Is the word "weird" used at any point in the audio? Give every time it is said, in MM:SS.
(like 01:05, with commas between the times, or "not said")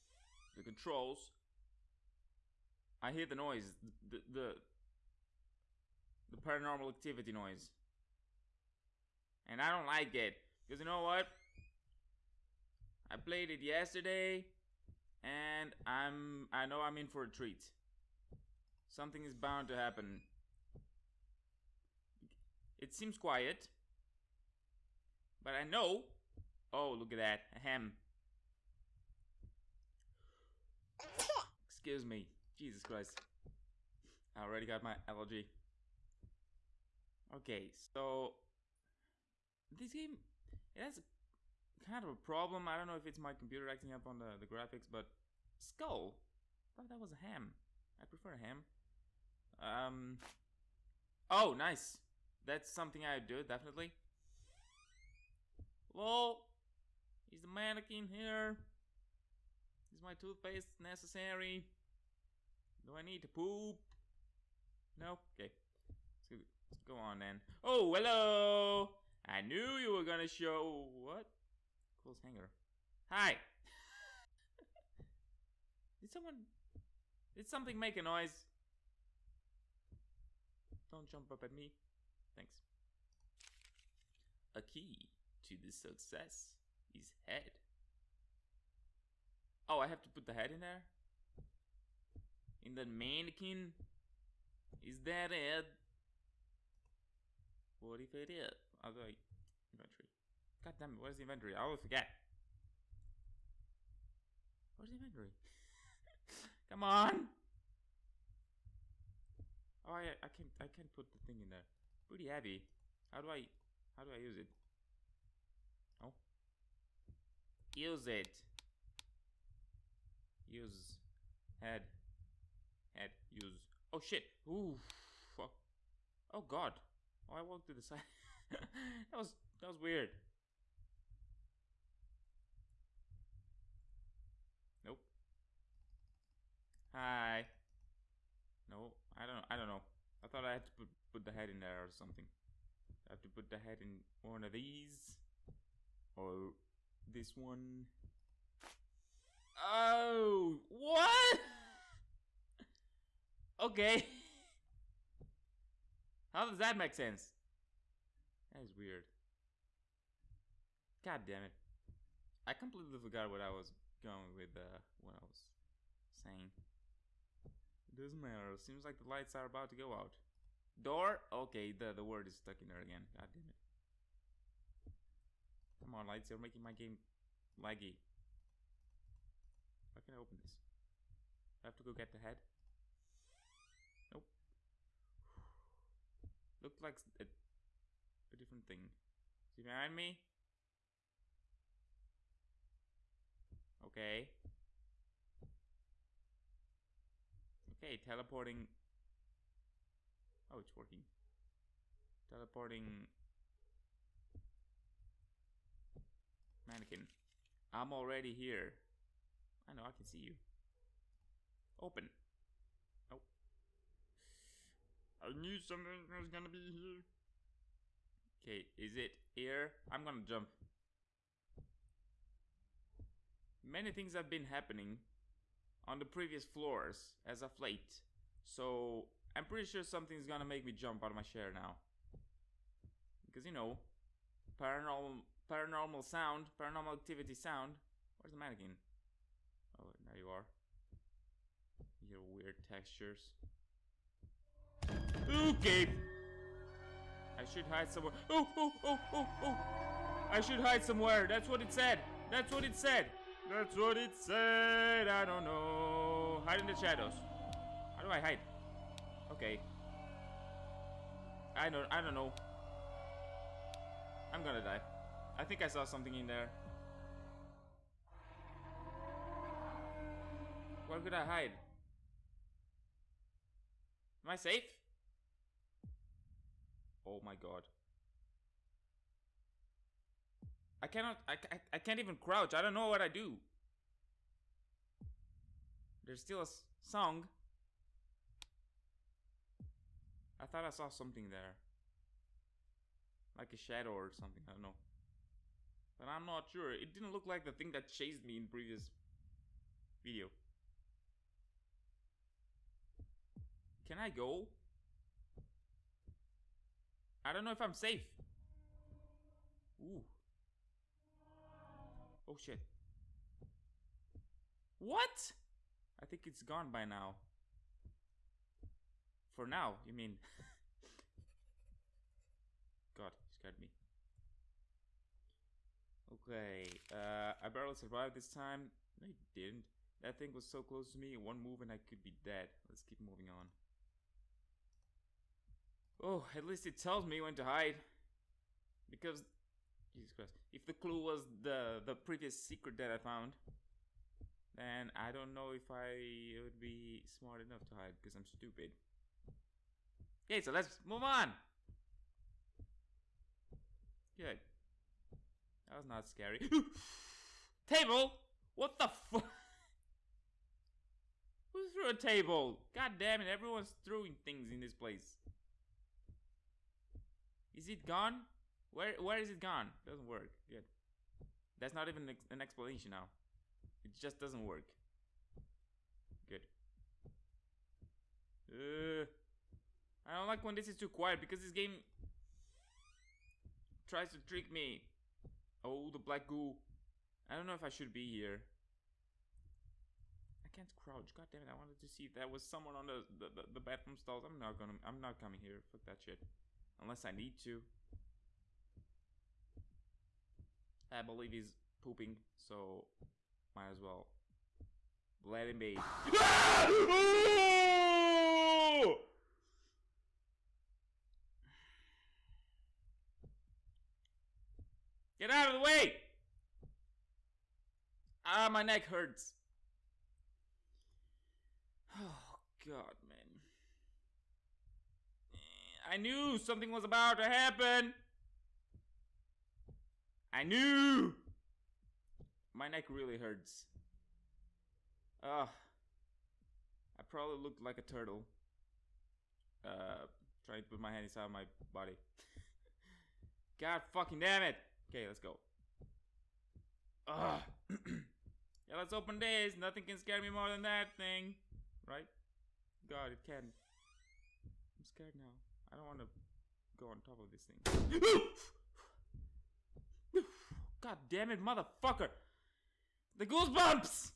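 02:09, 02:38, 04:02.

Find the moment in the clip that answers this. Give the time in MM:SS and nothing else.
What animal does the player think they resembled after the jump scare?
07:17.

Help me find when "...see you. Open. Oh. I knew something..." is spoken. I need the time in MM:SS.
03:30.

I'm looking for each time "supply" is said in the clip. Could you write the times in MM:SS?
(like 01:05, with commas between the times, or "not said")
not said.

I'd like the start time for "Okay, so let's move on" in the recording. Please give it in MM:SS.
05:50.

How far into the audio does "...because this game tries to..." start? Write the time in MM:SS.
06:21.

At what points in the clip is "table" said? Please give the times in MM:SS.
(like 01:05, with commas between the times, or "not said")
05:57, 06:01.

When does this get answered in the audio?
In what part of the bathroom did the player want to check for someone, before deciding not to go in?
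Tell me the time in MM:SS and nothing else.
06:33.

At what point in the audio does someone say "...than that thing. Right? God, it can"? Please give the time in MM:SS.
07:30.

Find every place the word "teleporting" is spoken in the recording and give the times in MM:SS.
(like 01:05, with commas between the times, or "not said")
03:17, 03:22.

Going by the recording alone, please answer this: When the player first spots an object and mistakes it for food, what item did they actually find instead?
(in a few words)
Skull.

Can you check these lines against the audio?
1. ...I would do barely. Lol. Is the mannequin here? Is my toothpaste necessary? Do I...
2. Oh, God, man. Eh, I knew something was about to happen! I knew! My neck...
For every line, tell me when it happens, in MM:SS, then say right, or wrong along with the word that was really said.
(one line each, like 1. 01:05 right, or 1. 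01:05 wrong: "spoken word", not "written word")
1. 00:53 wrong: "definitely", not "barely"
2. 07:01 right.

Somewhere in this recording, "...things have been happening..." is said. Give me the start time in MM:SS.
03:43.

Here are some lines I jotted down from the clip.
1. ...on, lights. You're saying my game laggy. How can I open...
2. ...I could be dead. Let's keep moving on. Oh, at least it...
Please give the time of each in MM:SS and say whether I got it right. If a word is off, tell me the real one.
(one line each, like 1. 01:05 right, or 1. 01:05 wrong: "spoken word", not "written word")
1. 02:55 wrong: "making", not "saying"
2. 05:31 right.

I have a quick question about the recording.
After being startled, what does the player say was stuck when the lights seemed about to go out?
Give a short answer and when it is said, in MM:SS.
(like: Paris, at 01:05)
The word, at 02:51.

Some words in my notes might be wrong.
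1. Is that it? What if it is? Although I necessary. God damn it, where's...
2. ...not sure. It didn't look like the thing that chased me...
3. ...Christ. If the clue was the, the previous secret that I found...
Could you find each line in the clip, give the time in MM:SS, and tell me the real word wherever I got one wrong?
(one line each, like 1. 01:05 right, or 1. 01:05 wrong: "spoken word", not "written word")
1. 01:34 wrong: "inventory", not "necessary"
2. 04:56 right
3. 05:40 right.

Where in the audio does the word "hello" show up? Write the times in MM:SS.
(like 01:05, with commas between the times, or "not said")
01:07.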